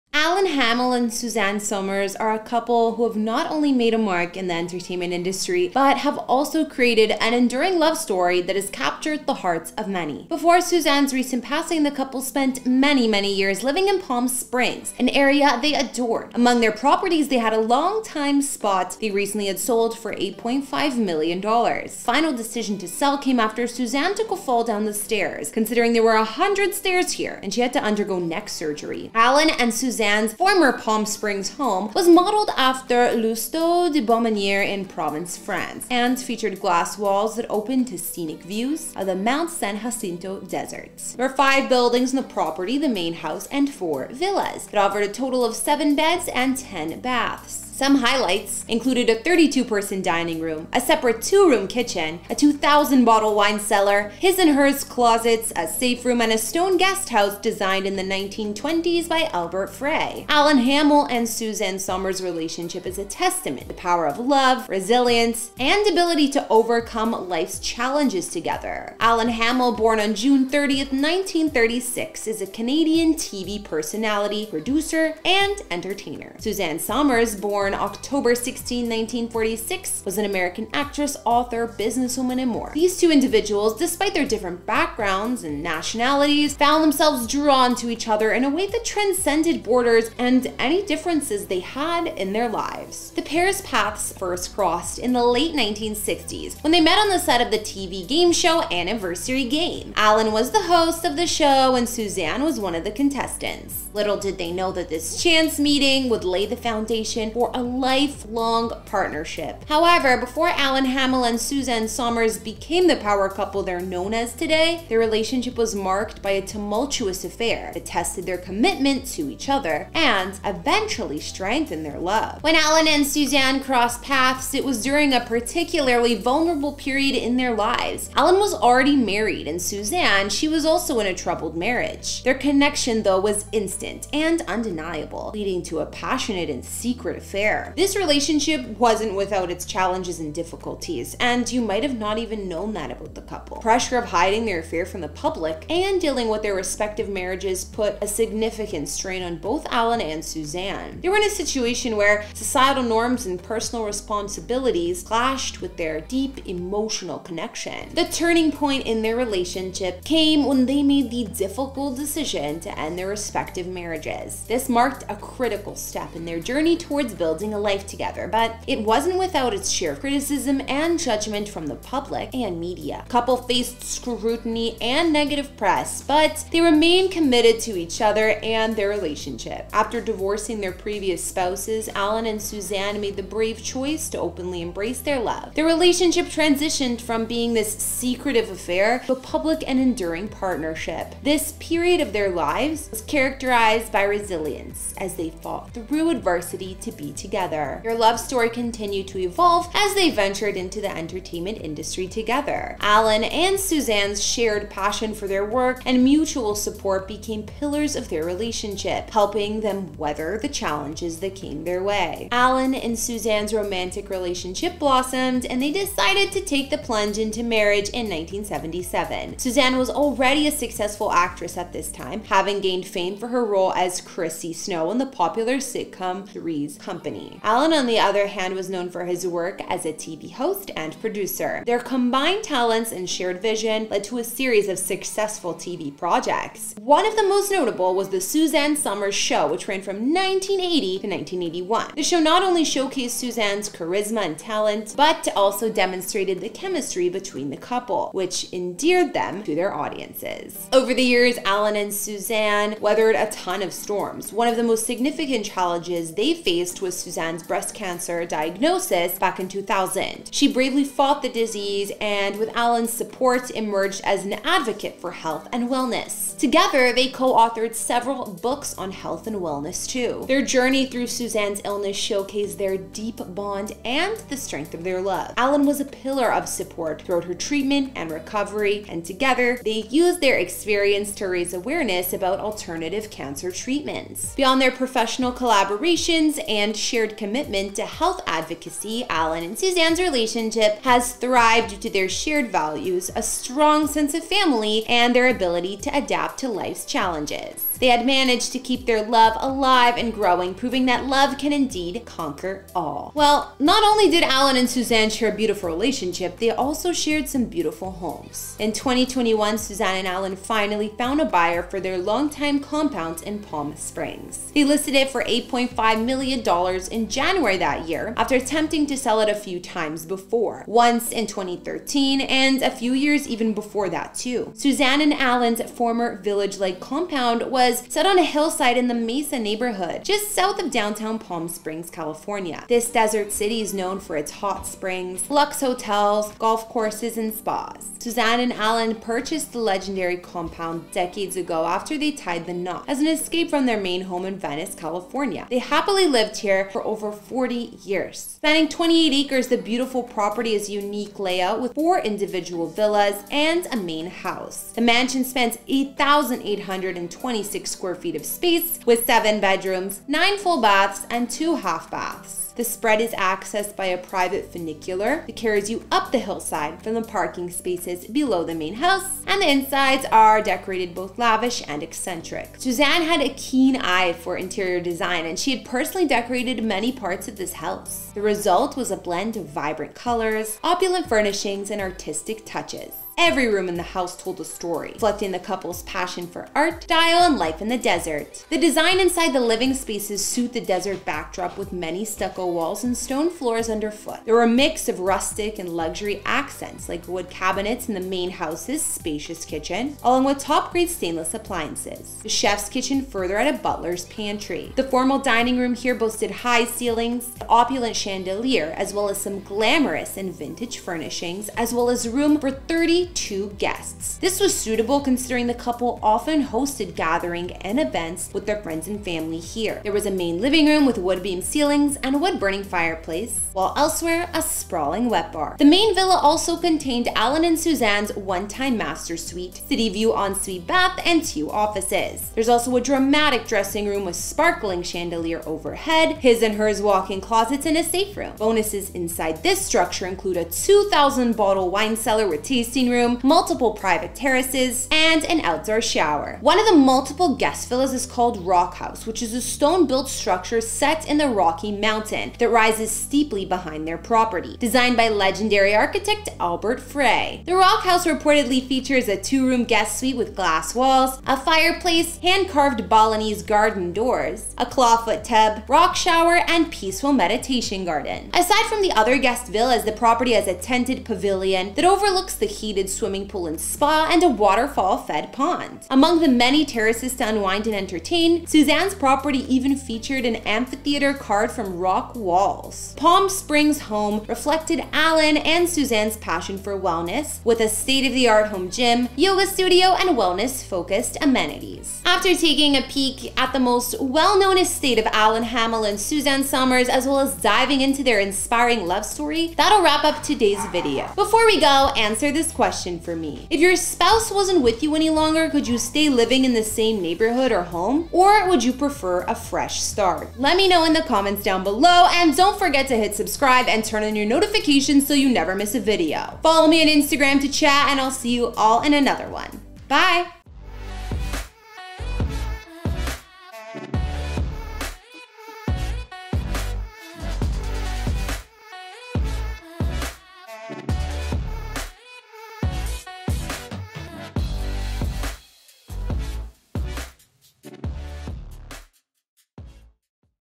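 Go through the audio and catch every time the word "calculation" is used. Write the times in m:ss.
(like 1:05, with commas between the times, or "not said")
not said.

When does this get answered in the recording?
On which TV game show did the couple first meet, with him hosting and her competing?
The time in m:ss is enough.
1:38.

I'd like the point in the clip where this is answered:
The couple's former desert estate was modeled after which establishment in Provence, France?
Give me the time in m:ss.
0:33.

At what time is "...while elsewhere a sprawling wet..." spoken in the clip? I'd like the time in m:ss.
7:03.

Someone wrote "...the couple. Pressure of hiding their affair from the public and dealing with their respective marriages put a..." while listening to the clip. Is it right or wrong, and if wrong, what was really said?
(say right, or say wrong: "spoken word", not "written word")
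right.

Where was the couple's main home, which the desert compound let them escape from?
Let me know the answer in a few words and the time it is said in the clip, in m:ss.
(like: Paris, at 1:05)
Venice, California, at 5:44.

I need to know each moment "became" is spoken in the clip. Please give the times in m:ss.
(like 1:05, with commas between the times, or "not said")
1:52, 3:27.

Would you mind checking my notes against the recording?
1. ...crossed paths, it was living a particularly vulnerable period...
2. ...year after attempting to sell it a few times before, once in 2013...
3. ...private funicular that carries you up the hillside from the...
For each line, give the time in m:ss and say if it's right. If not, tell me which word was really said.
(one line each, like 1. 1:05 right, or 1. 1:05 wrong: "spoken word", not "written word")
1. 2:03 wrong: "during", not "living"
2. 5:17 right
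3. 6:03 right.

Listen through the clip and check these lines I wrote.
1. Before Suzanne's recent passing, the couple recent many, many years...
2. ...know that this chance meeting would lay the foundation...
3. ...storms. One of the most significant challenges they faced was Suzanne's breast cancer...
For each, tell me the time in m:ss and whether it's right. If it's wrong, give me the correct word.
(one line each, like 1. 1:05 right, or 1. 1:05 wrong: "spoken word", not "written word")
1. 0:10 wrong: "spent", not "recent"
2. 1:44 right
3. 4:13 right.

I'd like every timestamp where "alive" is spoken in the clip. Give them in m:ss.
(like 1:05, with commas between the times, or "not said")
4:59.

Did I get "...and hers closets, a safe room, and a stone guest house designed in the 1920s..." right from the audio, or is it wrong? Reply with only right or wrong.
right.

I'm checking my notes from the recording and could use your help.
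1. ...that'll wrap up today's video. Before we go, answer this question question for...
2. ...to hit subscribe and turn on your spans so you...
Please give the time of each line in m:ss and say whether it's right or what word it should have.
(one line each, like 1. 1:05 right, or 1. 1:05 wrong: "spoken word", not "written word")
1. 8:19 right
2. 8:32 wrong: "notifications", not "spans".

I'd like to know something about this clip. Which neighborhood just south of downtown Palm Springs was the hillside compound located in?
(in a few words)
the Mesa.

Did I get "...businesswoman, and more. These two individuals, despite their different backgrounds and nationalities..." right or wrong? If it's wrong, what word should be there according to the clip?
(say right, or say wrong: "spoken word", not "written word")
right.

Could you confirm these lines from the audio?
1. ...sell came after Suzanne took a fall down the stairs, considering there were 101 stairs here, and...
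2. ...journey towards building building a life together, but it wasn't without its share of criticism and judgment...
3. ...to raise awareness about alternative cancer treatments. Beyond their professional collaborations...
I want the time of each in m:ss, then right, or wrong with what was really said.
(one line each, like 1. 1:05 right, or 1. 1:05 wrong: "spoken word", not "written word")
1. 0:22 wrong: "100", not "101"
2. 2:46 right
3. 4:41 right.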